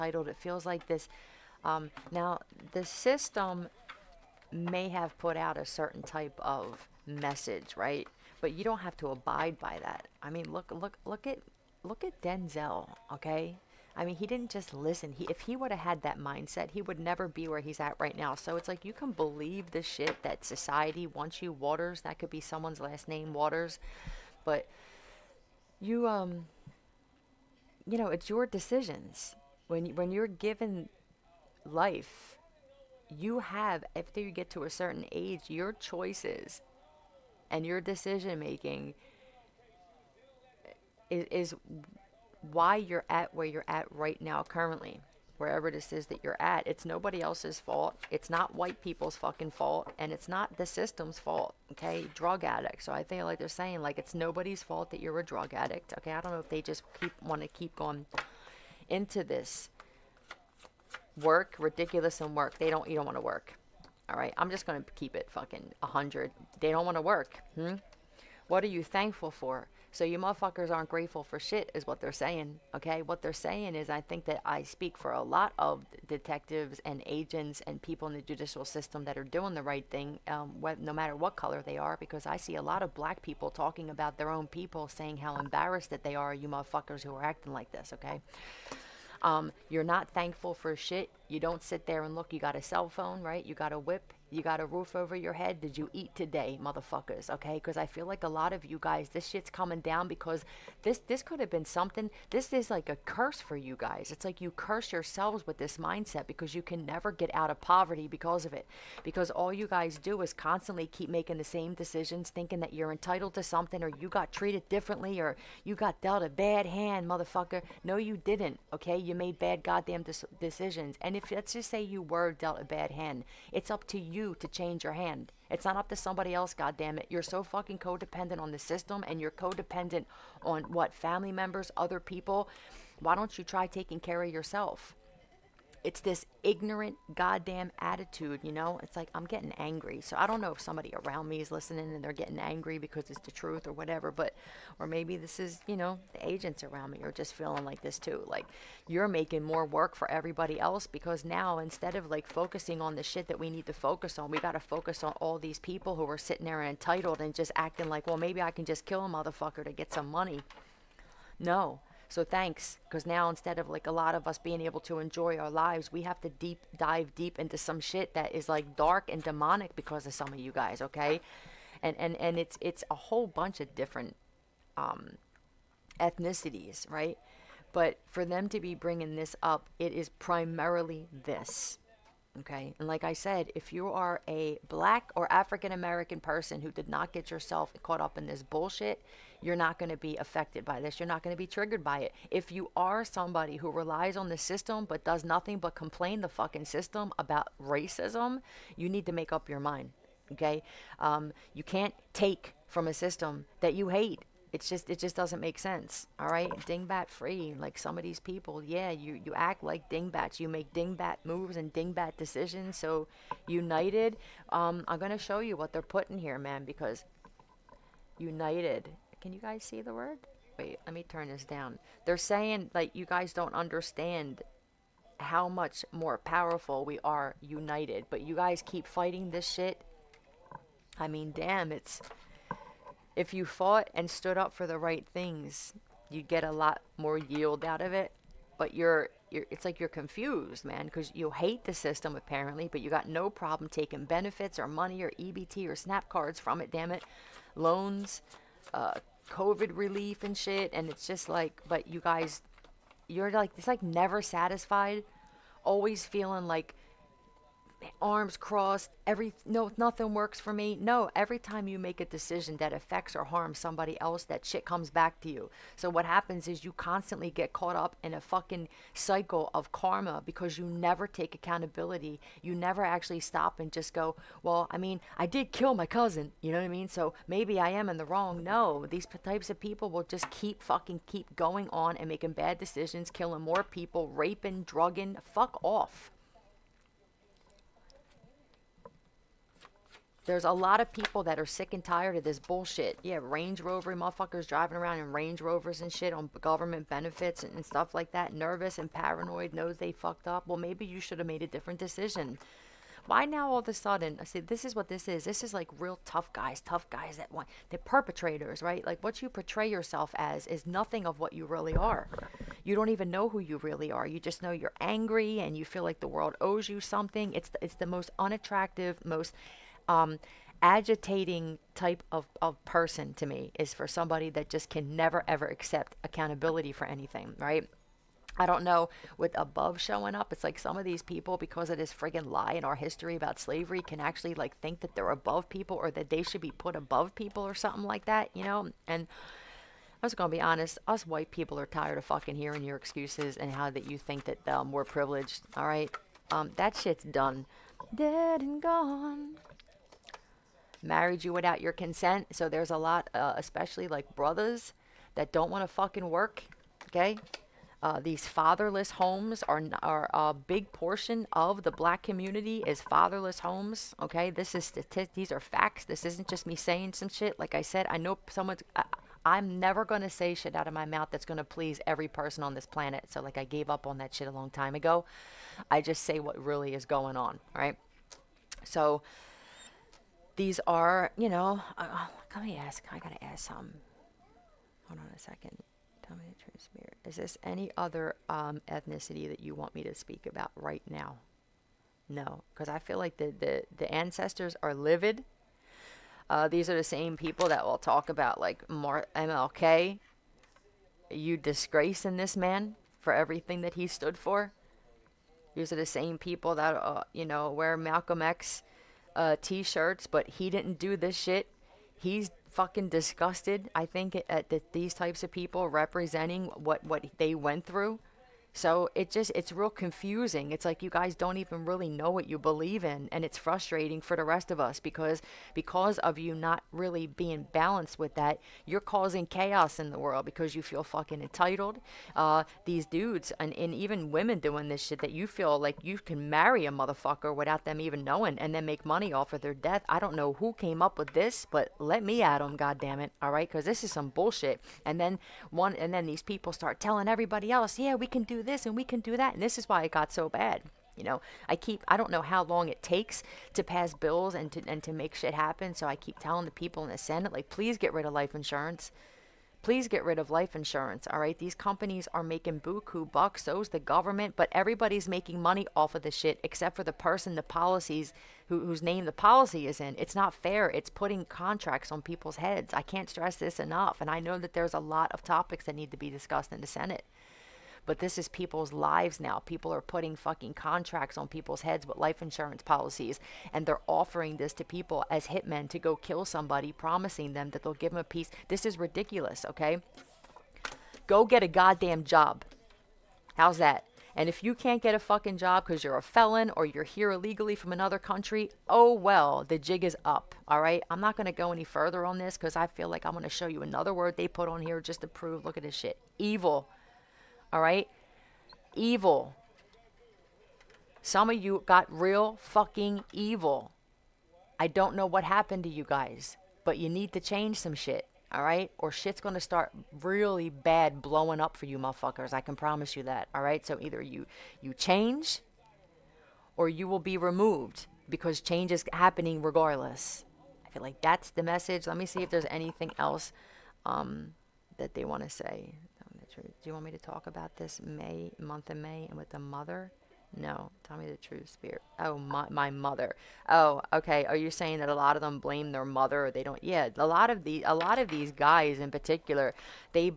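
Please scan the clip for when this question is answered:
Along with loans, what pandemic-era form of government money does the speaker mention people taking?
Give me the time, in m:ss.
4:09.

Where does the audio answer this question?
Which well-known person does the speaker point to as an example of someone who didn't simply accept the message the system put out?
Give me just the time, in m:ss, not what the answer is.
0:12.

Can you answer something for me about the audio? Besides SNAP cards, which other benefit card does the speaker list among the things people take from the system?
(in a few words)
EBT.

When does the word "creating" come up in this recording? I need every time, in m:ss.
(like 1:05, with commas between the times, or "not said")
not said.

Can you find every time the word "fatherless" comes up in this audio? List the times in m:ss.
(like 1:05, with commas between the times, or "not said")
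5:58, 6:02.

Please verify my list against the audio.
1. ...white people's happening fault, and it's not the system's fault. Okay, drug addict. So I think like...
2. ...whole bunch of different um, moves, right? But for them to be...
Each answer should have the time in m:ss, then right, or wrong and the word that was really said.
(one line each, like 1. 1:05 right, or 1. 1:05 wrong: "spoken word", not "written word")
1. 0:48 wrong: "fucking", not "happening"
2. 2:52 wrong: "ethnicities", not "moves".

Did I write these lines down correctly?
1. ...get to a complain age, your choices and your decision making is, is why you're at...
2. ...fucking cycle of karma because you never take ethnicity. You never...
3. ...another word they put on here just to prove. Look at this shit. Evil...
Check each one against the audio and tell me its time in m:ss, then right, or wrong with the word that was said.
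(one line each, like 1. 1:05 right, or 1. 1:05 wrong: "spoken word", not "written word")
1. 0:34 wrong: "certain", not "complain"
2. 4:28 wrong: "accountability", not "ethnicity"
3. 8:23 right.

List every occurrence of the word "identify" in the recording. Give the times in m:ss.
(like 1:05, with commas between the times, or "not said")
not said.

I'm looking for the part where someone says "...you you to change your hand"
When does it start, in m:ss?
2:03.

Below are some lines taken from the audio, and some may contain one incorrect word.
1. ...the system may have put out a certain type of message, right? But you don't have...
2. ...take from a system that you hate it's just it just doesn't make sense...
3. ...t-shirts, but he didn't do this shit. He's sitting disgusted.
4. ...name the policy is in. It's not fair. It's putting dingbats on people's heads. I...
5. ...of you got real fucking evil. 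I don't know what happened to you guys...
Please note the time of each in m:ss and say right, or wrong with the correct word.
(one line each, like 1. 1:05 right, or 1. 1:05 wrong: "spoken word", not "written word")
1. 0:02 right
2. 3:22 right
3. 6:49 wrong: "fucking", not "sitting"
4. 7:48 wrong: "contracts", not "dingbats"
5. 8:31 right.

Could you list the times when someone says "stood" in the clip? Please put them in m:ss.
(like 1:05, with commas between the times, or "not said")
3:54, 6:43.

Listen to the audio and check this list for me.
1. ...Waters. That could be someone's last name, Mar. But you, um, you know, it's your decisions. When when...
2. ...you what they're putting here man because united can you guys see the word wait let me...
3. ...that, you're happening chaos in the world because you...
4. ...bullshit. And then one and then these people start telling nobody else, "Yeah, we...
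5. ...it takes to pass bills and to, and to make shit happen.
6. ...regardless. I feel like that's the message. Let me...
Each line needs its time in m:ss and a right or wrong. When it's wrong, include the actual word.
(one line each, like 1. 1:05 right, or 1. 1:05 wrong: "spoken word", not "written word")
1. 0:21 wrong: "Waters", not "Mar"
2. 3:35 right
3. 7:08 wrong: "causing", not "happening"
4. 7:24 wrong: "everybody", not "nobody"
5. 7:32 right
6. 8:49 right.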